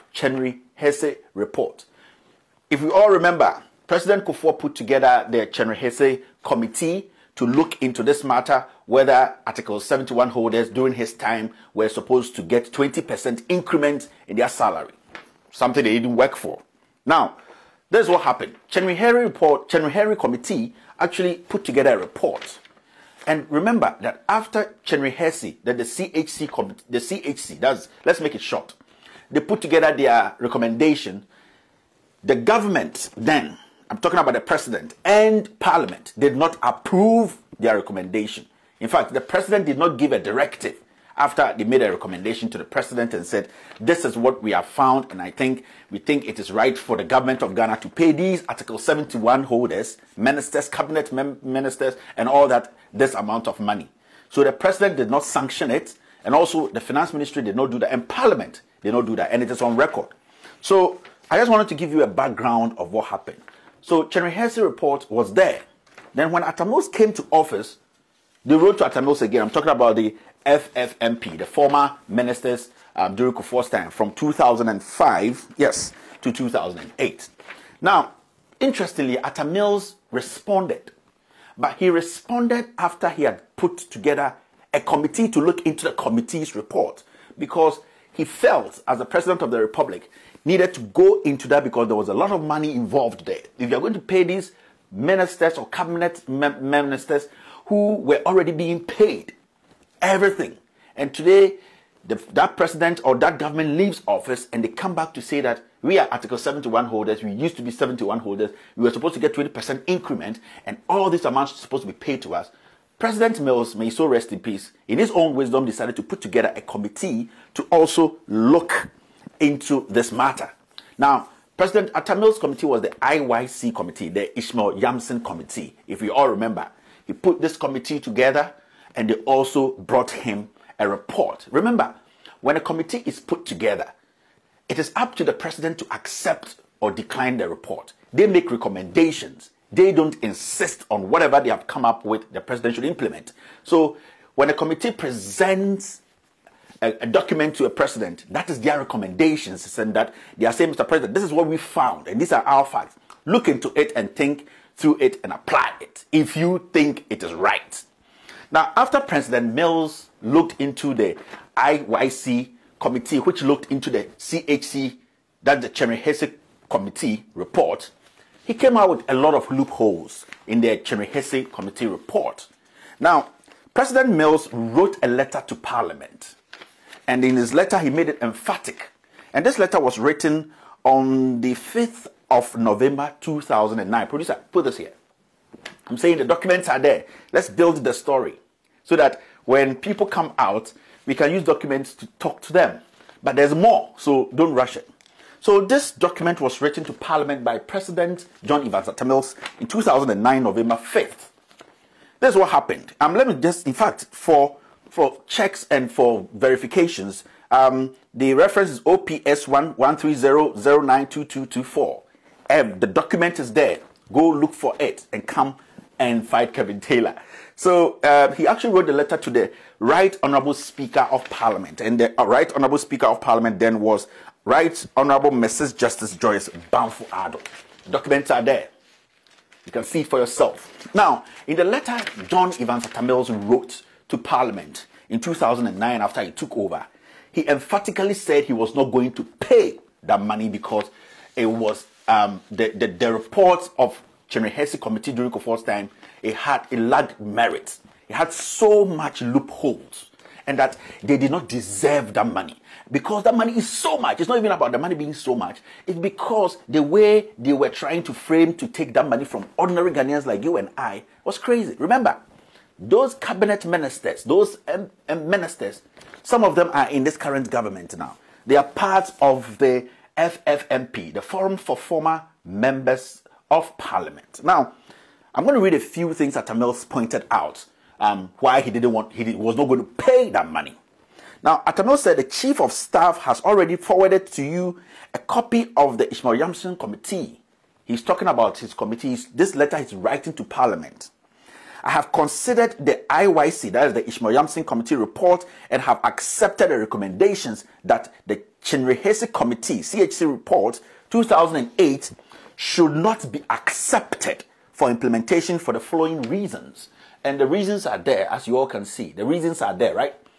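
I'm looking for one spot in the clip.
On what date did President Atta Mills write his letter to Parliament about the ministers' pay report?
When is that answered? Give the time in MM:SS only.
03:01.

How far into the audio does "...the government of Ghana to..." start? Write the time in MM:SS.
00:46.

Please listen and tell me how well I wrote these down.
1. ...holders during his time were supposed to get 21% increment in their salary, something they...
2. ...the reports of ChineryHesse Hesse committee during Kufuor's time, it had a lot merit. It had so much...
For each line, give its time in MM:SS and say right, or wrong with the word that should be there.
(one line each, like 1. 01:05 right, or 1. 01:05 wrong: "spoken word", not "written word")
1. 00:10 wrong: "20", not "21"
2. 04:02 wrong: "Chairman", not "ChineryHesse".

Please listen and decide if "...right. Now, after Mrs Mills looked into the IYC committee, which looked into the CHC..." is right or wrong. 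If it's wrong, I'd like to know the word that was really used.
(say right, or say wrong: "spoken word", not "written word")
wrong: "President", not "Mrs".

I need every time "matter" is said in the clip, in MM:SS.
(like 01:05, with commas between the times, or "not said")
00:08, 02:00.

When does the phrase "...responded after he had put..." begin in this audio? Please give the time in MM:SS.
01:21.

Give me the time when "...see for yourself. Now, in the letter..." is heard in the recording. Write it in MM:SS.
03:49.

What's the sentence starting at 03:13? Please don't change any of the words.
But there's more, so don't rush it.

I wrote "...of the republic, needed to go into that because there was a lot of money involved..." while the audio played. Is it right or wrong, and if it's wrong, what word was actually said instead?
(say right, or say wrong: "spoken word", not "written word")
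right.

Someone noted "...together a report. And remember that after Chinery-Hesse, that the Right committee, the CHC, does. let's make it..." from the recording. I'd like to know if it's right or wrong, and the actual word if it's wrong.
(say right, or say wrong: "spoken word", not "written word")
wrong: "CHC", not "Right".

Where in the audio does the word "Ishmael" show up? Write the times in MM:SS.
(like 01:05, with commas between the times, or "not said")
02:04, 04:46, 04:54.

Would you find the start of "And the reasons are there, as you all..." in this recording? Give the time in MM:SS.
05:07.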